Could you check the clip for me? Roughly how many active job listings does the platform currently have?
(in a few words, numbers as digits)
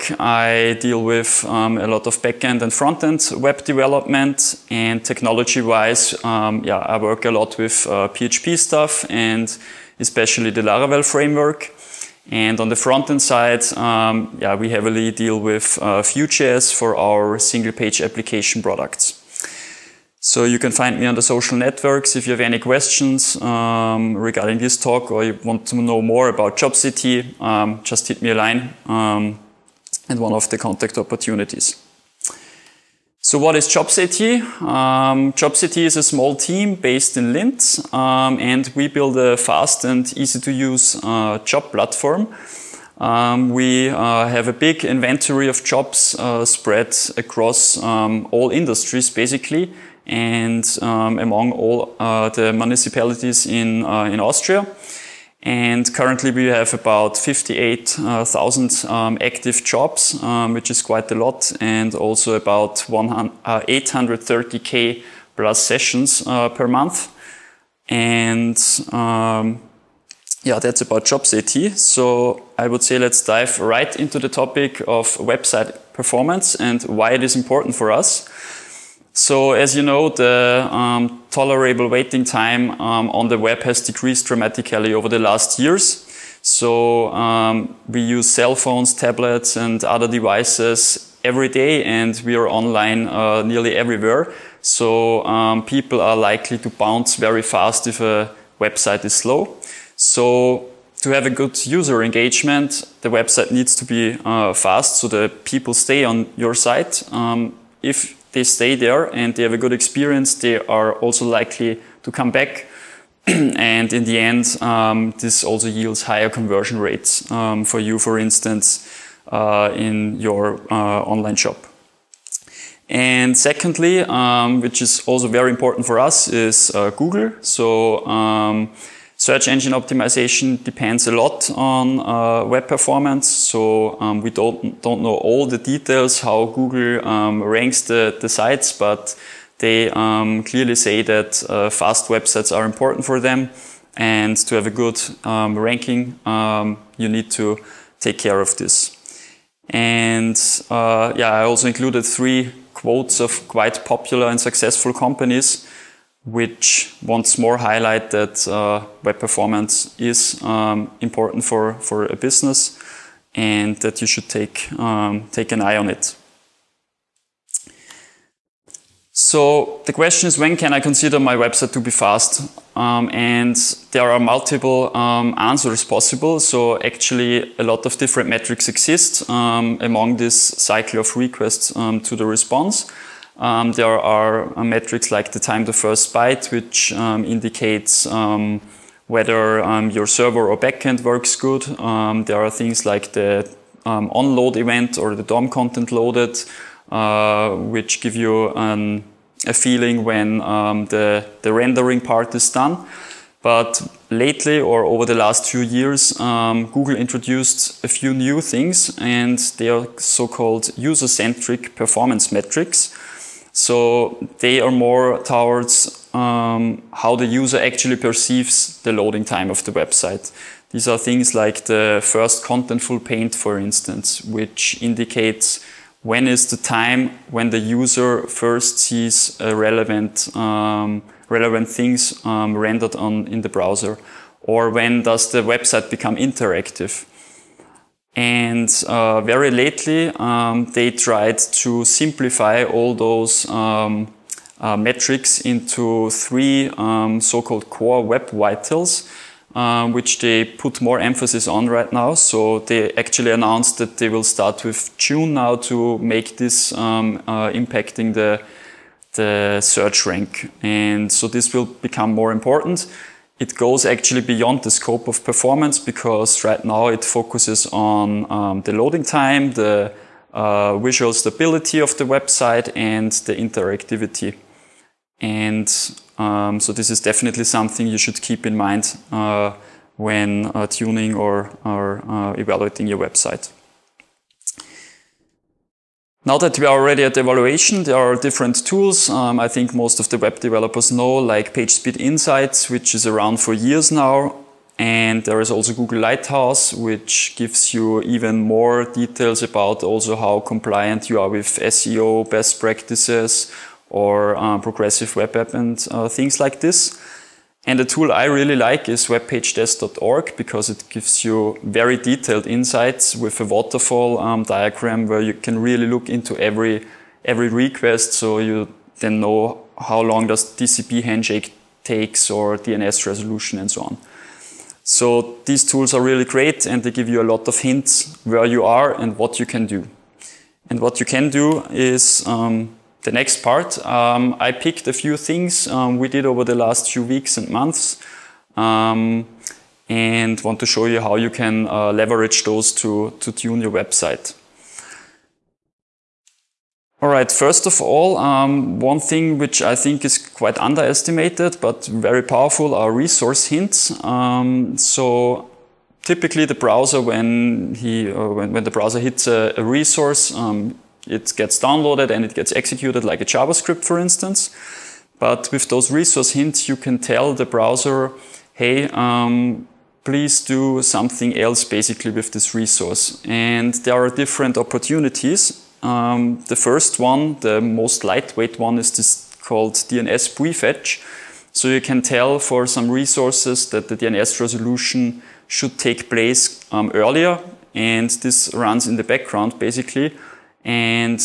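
58,000.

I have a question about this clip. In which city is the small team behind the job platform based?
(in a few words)
Linz.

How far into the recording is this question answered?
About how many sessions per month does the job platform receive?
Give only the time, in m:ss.
1:02.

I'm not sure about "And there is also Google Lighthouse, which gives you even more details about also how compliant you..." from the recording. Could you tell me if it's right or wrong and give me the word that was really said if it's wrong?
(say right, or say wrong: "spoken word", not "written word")
right.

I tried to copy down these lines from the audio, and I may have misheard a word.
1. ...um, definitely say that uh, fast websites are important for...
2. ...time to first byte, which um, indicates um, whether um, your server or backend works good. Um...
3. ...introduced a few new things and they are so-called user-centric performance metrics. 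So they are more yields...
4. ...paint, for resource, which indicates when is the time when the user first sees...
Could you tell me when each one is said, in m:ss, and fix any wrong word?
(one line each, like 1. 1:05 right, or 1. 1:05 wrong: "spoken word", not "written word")
1. 2:19 wrong: "clearly", not "definitely"
2. 3:05 right
3. 3:26 wrong: "towards", not "yields"
4. 3:43 wrong: "instance", not "resource".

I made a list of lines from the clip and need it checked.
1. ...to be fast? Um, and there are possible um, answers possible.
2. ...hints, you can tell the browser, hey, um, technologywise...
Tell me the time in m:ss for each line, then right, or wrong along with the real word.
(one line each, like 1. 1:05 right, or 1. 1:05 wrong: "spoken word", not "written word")
1. 2:51 wrong: "multiple", not "possible"
2. 6:06 wrong: "please", not "technologywise".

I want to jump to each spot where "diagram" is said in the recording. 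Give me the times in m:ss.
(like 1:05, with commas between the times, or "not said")
5:14.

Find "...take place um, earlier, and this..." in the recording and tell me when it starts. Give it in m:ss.
6:25.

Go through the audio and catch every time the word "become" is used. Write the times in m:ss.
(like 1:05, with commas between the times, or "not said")
3:55, 4:21.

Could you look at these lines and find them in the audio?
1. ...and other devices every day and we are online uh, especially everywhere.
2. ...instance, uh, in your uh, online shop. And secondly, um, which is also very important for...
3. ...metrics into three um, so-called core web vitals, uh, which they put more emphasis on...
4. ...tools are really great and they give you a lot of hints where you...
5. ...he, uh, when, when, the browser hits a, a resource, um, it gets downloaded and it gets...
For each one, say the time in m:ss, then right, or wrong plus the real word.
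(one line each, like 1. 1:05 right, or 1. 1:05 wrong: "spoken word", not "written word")
1. 1:29 wrong: "nearly", not "especially"
2. 1:58 right
3. 4:04 right
4. 5:25 right
5. 5:57 right.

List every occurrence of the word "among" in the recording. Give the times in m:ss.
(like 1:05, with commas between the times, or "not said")
0:51, 2:59.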